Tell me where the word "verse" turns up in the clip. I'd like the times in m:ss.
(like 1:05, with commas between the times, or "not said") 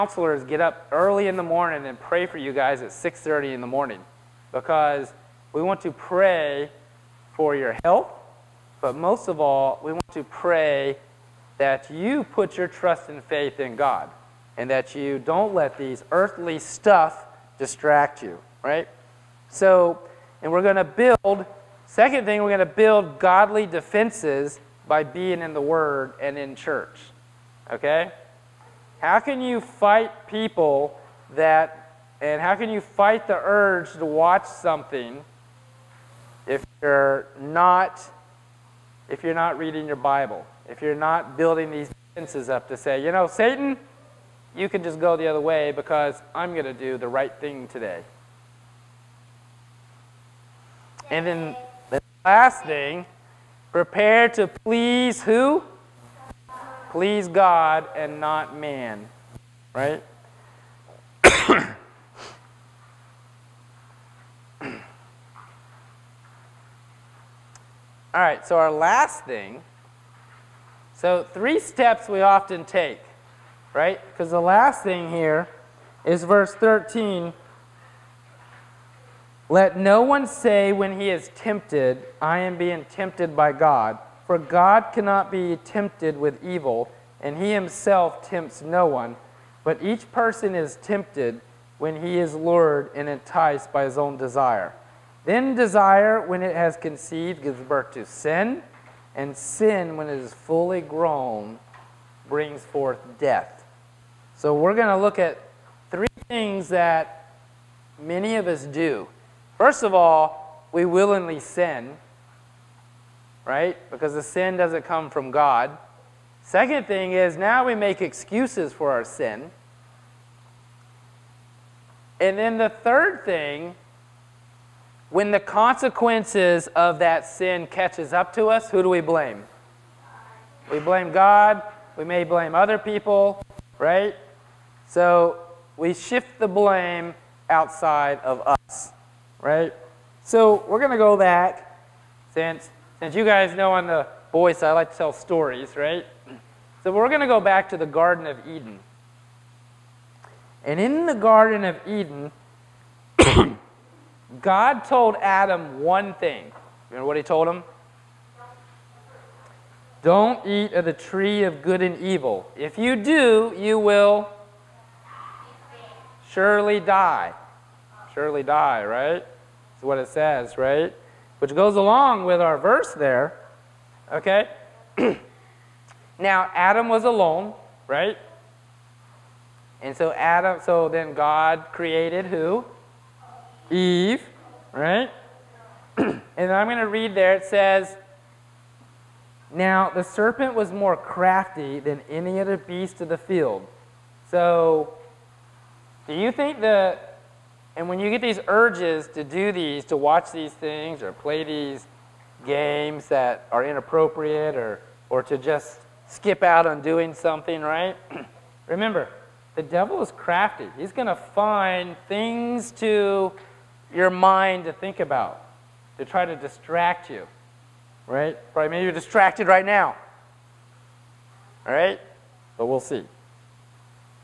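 1:16, 2:52.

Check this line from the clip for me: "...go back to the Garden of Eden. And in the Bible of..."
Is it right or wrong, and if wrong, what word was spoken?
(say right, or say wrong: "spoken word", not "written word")
wrong: "Garden", not "Bible".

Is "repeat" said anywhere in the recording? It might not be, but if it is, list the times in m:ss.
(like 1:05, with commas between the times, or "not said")
not said.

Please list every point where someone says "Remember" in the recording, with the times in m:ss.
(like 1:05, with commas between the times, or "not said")
2:36, 3:28.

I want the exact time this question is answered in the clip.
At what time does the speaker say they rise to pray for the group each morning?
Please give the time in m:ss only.
0:02.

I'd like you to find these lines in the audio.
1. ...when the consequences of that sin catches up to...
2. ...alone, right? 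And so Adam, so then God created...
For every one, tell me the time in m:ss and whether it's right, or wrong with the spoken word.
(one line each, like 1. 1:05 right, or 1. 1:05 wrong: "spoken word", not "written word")
1. 2:05 right
2. 2:57 right.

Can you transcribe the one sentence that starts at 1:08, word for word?
All right, so our last thing, so three steps we often take, right?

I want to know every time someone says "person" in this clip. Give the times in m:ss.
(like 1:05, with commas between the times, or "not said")
1:30.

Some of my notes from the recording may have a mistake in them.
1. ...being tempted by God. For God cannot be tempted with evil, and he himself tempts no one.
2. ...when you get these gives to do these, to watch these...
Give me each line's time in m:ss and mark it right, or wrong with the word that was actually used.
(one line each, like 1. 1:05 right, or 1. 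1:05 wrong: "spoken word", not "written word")
1. 1:22 right
2. 3:17 wrong: "urges", not "gives".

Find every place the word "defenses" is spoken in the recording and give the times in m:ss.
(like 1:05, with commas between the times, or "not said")
0:23, 0:42.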